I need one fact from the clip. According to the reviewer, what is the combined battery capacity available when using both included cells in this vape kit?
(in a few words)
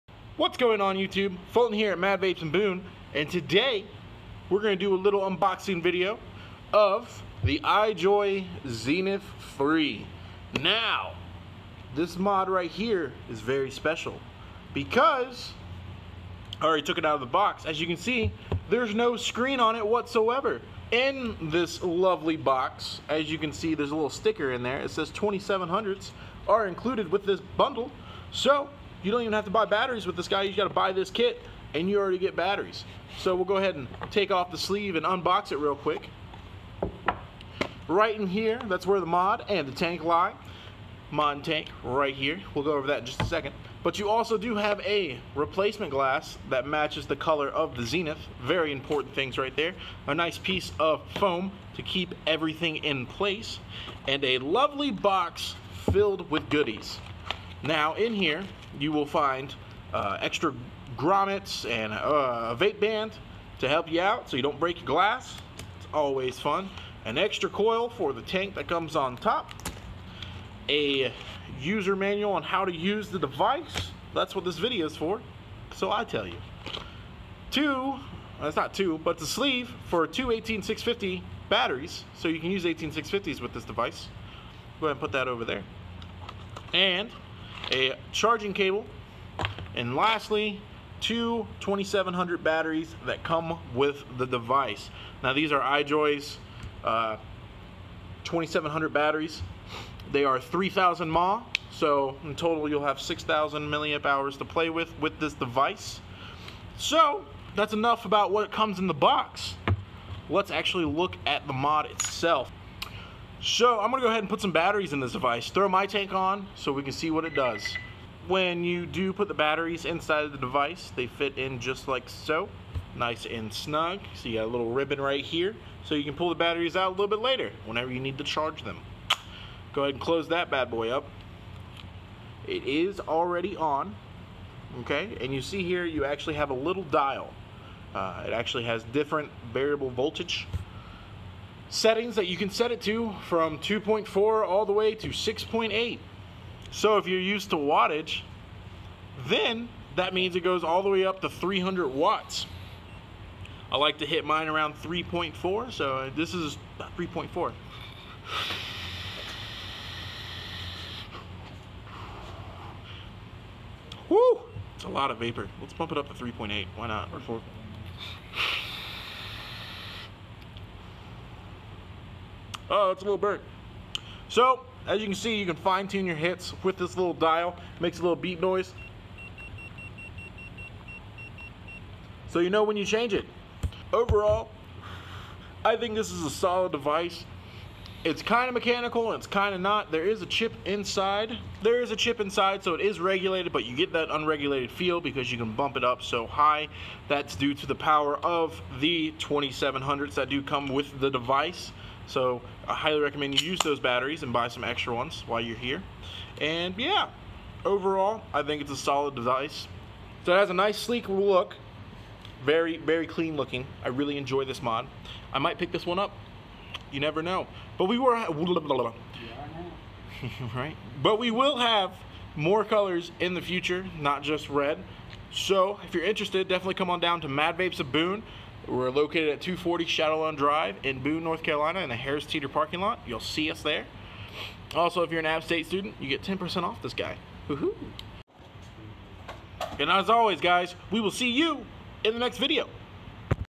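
6000 mAh.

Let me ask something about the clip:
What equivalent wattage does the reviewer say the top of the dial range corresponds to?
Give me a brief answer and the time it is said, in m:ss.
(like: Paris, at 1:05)
300 watts, at 2:31.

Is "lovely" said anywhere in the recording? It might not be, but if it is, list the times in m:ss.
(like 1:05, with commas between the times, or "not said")
0:21, 0:54.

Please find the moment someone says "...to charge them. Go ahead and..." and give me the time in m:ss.
2:08.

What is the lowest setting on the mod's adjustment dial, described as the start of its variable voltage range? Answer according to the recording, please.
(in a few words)
2.4.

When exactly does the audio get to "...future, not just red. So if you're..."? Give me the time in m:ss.
3:43.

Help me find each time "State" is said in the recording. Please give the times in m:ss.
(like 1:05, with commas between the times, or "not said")
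3:55.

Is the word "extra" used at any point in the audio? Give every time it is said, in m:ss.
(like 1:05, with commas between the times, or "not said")
1:00, 1:07, 3:24.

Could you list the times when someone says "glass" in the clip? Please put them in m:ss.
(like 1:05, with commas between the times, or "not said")
0:45, 1:04.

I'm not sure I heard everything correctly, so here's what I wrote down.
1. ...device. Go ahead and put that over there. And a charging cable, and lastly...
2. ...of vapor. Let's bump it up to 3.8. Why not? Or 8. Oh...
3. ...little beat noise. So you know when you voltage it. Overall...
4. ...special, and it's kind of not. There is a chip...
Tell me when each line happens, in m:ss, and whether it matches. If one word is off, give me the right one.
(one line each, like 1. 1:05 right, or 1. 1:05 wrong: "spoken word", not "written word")
1. 1:23 right
2. 2:45 wrong: "4", not "8"
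3. 2:58 wrong: "change", not "voltage"
4. 3:08 wrong: "mechanical", not "special".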